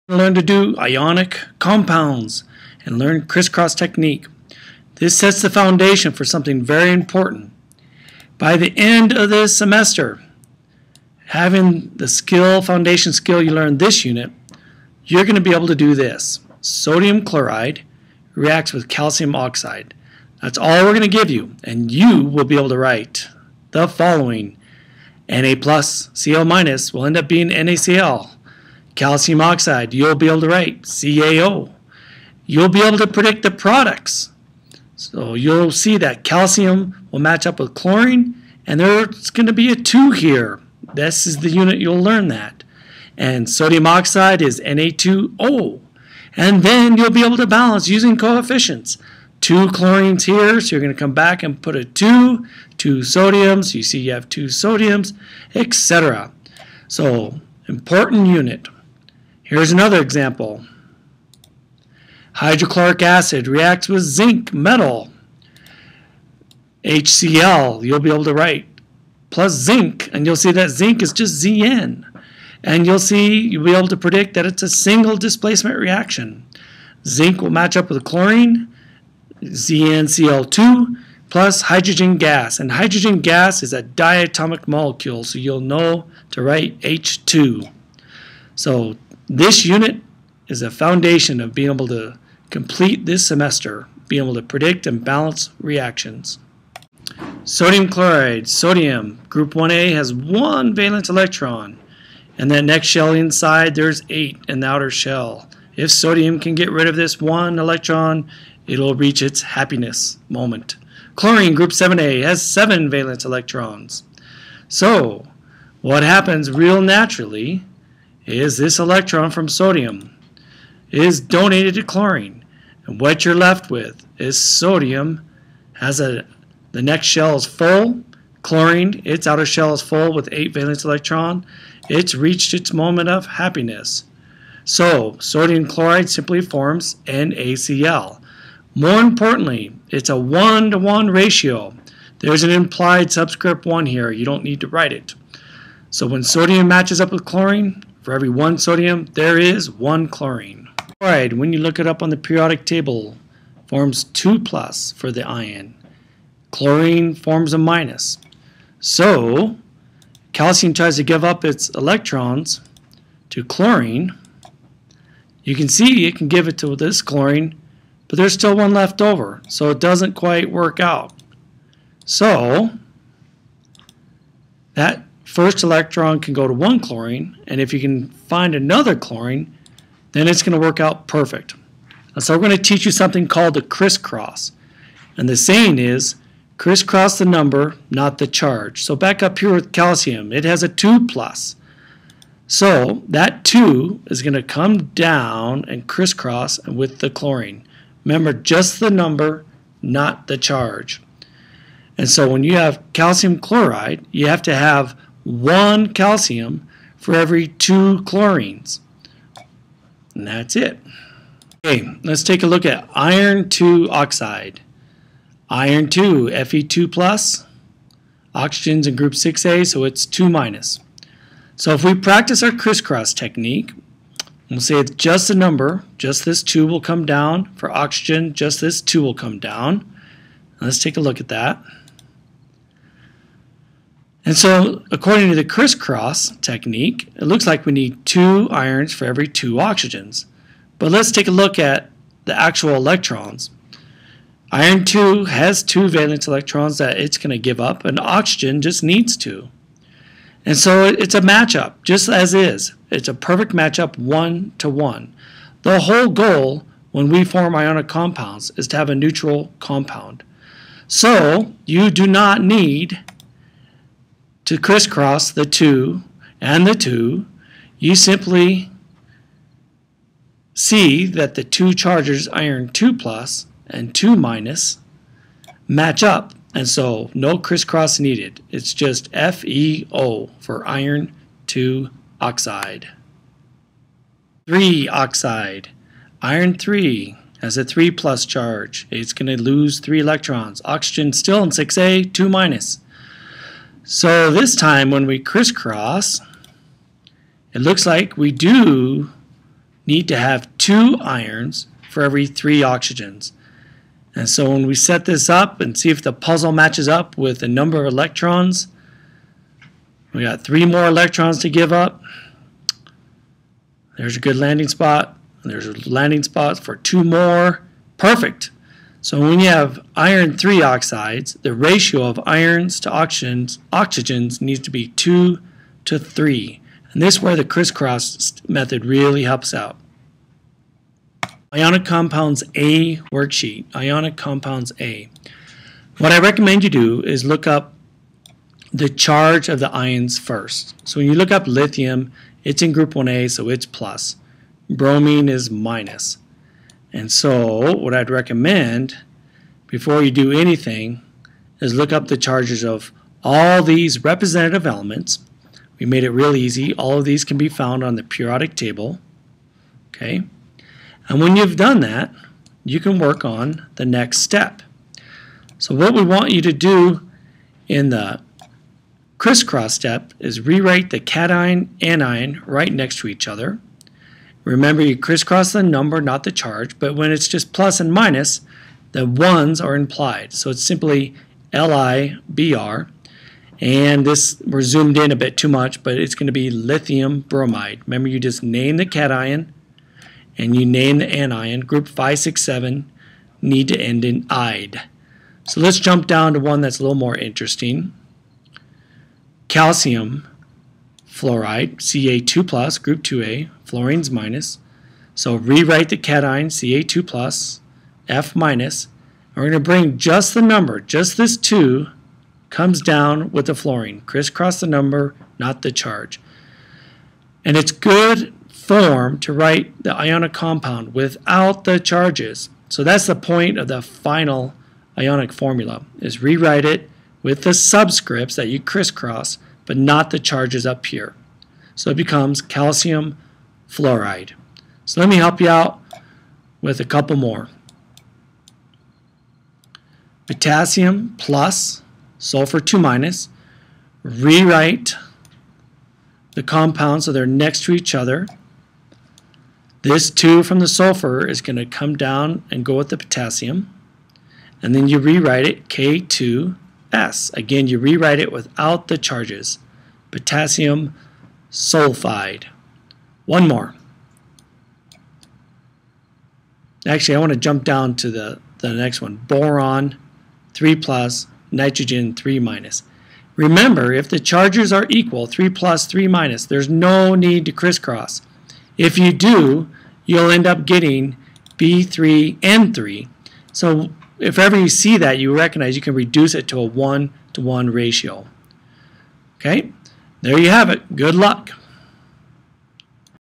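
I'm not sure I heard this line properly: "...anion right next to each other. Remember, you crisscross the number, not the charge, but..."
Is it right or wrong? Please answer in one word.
right.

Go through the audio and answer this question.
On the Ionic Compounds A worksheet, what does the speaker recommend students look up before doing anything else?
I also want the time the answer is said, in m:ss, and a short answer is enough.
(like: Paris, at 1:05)
the charge of the ions, at 5:38.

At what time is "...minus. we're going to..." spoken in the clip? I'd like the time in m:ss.
6:48.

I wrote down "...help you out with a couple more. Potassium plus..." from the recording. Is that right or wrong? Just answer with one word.
right.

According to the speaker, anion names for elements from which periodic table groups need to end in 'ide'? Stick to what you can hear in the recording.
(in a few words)
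567.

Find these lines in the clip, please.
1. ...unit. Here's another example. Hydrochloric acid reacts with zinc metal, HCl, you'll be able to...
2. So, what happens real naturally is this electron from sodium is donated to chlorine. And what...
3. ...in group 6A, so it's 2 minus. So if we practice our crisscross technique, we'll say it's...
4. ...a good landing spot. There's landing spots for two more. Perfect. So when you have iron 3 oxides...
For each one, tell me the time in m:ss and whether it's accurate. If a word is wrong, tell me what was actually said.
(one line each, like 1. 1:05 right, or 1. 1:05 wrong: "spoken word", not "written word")
1. 0:58 right
2. 1:54 right
3. 3:38 right
4. 5:14 right.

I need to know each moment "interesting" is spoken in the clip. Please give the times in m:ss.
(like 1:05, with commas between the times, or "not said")
6:37.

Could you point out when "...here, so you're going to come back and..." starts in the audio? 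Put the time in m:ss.
0:50.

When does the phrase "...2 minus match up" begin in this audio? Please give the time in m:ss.
4:33.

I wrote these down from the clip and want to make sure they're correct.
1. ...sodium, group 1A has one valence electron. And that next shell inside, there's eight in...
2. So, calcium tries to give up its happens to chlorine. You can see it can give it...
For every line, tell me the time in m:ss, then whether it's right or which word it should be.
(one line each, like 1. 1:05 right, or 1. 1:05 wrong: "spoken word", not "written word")
1. 1:38 right
2. 2:38 wrong: "electrons", not "happens".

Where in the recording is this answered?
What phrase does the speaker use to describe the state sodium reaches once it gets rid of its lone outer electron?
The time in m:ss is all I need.
1:49.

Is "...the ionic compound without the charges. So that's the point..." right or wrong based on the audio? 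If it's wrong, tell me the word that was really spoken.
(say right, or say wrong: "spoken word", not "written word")
right.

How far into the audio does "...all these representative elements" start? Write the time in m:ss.
5:53.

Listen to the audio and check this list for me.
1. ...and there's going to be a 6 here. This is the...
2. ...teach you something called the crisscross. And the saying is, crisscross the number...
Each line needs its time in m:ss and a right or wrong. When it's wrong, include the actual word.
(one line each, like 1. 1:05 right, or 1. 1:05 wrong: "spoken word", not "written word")
1. 0:38 wrong: "2", not "6"
2. 3:02 right.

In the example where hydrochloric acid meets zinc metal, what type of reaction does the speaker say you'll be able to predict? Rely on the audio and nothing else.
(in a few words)
single displacement.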